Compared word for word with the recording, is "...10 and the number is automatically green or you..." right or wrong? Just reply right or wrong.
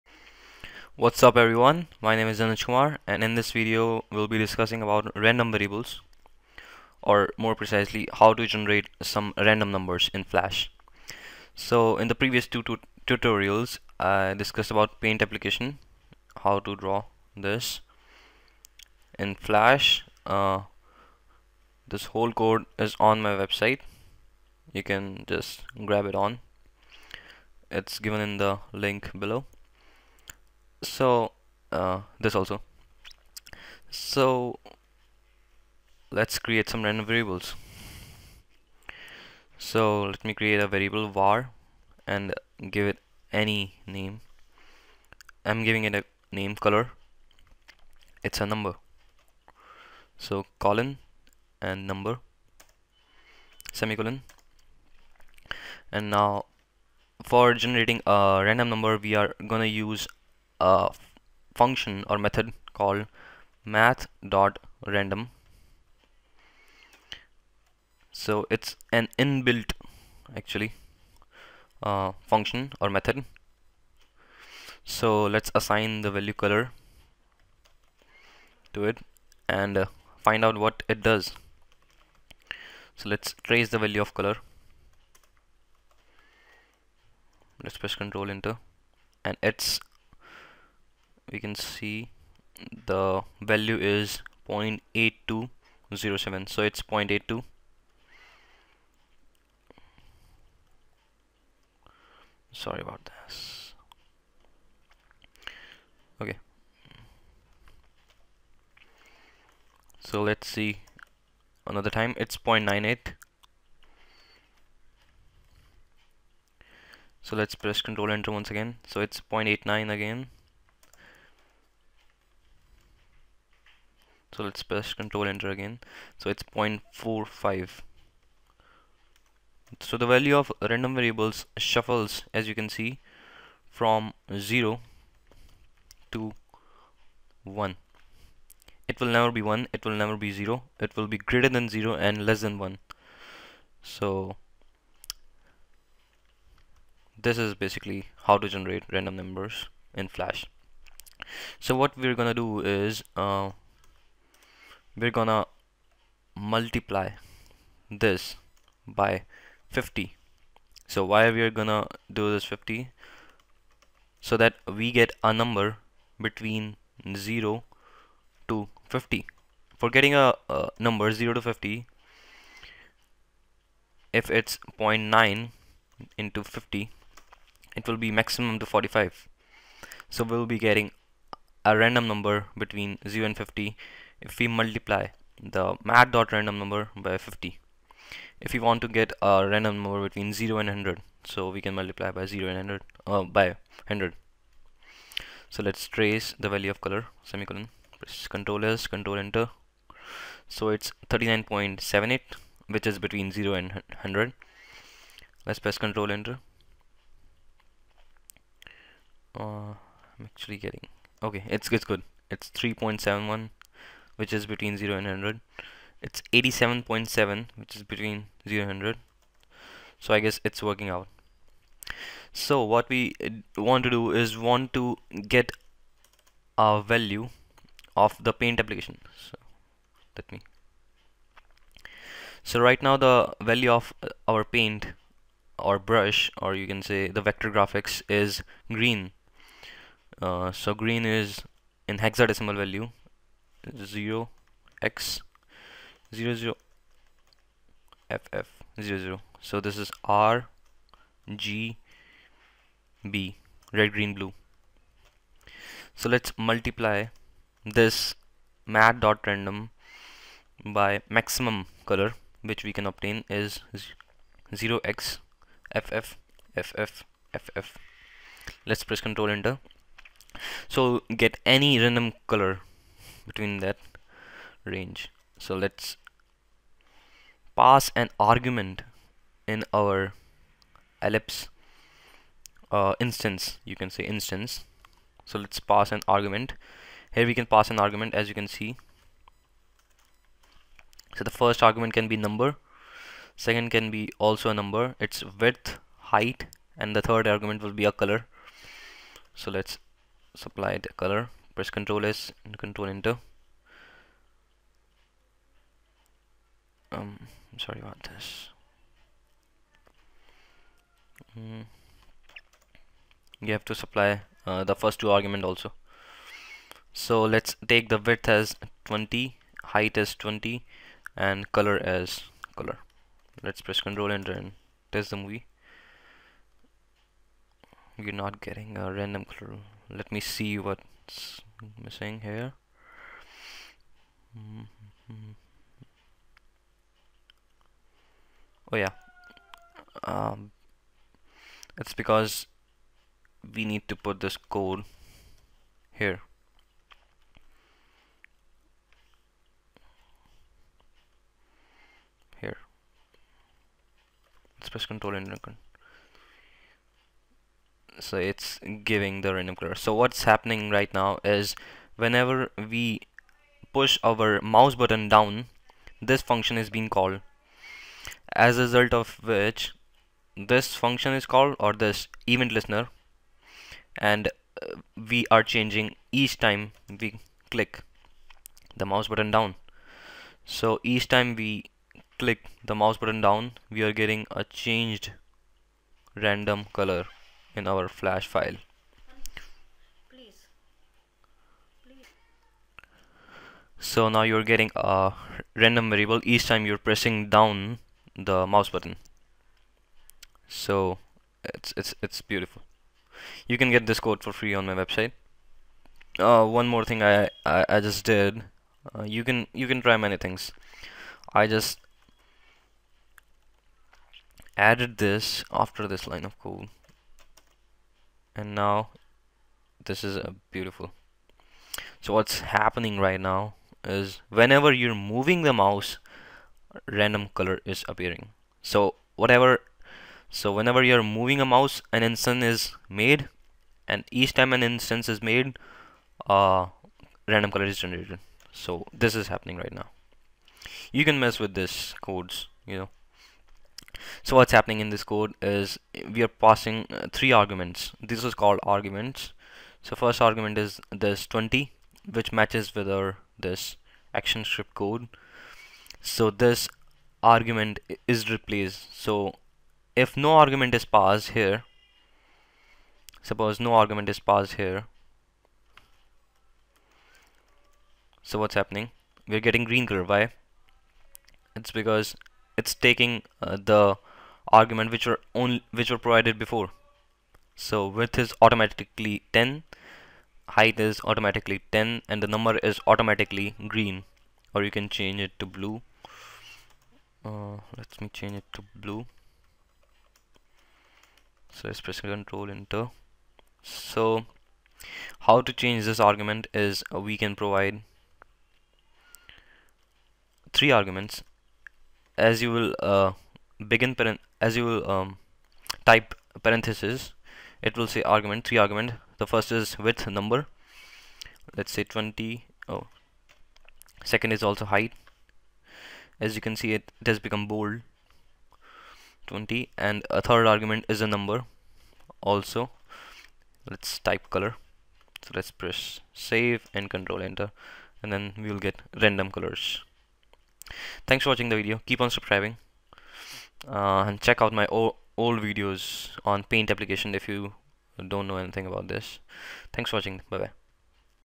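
right.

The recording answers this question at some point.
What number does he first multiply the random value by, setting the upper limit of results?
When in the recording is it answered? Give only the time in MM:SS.
02:36.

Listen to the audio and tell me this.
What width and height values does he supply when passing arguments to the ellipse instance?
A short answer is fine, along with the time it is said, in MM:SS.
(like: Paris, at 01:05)
20, at 05:17.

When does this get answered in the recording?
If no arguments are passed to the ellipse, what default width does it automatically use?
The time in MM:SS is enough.
07:57.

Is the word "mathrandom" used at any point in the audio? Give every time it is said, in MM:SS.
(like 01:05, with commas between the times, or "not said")
01:03, 03:05.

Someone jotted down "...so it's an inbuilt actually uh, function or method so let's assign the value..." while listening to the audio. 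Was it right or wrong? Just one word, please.
right.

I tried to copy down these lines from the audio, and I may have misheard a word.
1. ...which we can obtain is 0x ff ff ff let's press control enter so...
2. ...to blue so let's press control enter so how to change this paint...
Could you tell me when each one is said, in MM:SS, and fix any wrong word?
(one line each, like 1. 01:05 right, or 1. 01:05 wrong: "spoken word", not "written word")
1. 04:22 right
2. 08:08 wrong: "argument", not "paint".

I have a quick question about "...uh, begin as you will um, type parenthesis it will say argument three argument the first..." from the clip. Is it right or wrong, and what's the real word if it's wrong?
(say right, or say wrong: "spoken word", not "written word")
right.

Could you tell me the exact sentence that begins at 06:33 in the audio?
So now you're getting a random variable each time you're pressing down the mouse button.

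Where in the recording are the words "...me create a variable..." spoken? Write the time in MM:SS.
00:40.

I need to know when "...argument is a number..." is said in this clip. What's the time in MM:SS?
08:40.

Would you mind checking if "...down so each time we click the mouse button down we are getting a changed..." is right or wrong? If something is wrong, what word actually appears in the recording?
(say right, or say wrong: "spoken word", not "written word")
right.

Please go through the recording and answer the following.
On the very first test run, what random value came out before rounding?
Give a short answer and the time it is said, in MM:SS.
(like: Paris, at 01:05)
0.8207, at 01:34.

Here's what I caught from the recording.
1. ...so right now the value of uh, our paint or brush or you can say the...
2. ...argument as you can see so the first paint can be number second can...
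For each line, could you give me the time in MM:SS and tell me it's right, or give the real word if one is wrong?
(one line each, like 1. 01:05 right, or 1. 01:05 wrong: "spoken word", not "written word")
1. 03:52 right
2. 04:47 wrong: "argument", not "paint".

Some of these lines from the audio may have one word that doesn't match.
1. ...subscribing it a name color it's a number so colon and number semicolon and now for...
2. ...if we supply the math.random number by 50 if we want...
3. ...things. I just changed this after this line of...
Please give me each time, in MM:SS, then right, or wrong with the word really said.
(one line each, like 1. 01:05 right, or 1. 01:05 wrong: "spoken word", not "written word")
1. 00:45 wrong: "giving", not "subscribing"
2. 03:04 wrong: "multiply", not "supply"
3. 06:50 wrong: "added", not "changed".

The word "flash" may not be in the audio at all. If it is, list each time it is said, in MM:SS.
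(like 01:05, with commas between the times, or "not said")
00:10, 00:19, 02:30, 06:27.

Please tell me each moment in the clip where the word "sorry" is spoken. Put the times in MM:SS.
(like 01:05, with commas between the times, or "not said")
01:42, 05:07.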